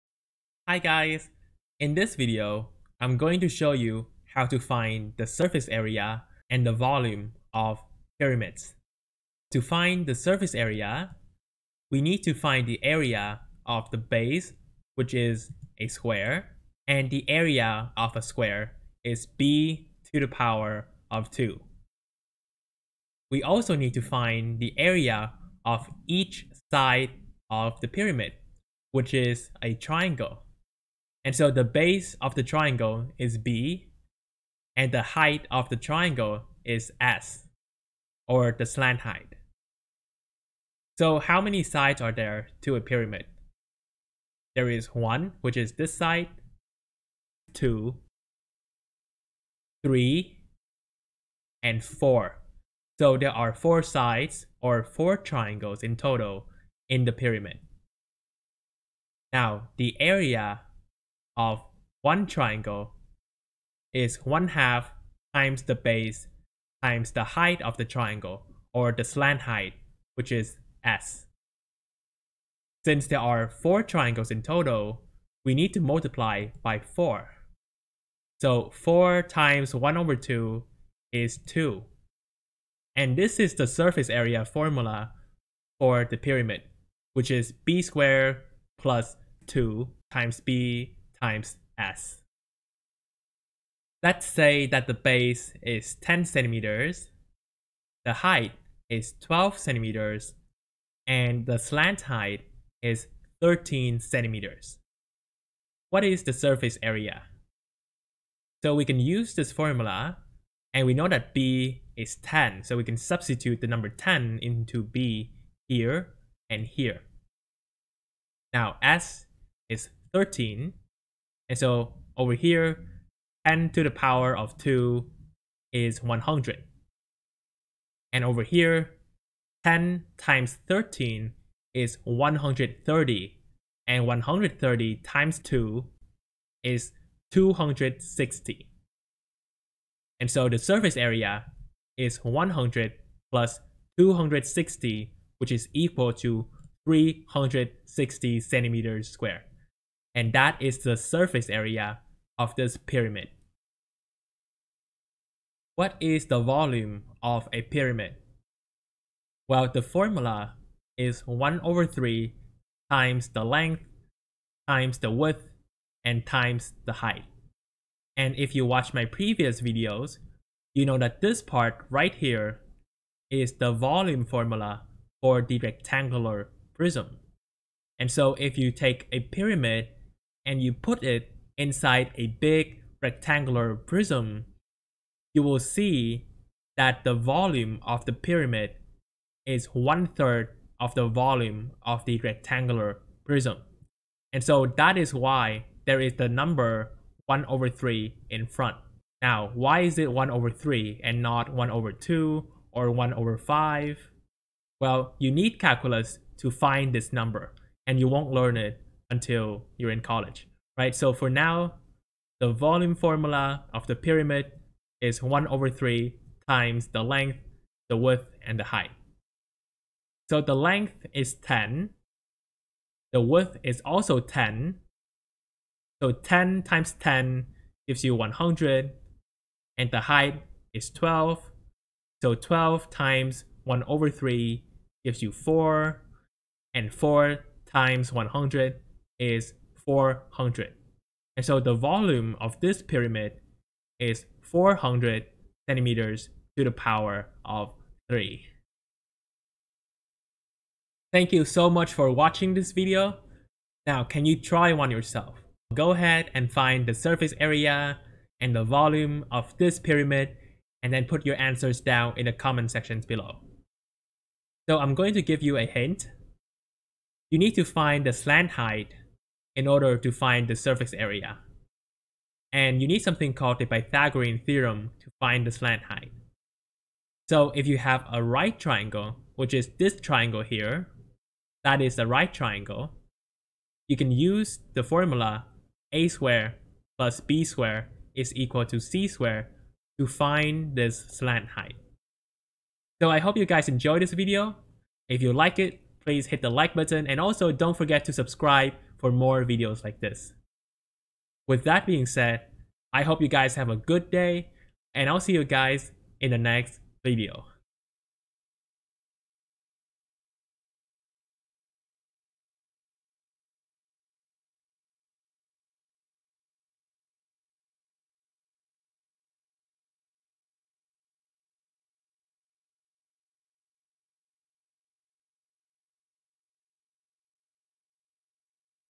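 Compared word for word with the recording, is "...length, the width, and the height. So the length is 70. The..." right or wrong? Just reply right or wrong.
wrong.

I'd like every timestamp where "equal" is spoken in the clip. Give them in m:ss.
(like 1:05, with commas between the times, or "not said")
2:25, 4:48.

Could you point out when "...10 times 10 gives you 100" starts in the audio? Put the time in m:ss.
3:46.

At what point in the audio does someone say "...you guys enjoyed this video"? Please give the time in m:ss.
4:53.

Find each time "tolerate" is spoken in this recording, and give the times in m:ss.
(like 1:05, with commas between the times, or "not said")
not said.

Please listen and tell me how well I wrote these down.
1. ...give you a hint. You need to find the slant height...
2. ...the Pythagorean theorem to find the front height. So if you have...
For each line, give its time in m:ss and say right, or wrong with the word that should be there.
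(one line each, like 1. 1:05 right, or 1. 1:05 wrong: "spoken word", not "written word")
1. 4:25 right
2. 4:33 wrong: "slant", not "front".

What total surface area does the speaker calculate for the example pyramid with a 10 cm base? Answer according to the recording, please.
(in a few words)
360 square centimeters.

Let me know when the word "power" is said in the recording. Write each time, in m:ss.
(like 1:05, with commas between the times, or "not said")
0:20, 2:03, 4:06.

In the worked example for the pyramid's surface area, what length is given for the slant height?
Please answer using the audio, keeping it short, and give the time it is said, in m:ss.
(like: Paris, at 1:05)
13 centimeters, at 1:43.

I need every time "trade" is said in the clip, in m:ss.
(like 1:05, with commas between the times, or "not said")
not said.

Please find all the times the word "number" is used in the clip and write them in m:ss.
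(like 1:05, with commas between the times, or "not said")
1:53, 3:16, 3:27.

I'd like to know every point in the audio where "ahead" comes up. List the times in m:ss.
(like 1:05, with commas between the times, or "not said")
4:15.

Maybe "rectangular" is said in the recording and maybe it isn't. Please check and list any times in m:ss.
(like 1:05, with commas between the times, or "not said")
2:55, 3:03, 3:12.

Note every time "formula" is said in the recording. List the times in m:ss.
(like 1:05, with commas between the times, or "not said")
1:24, 1:49, 2:39, 2:54, 3:32, 4:44.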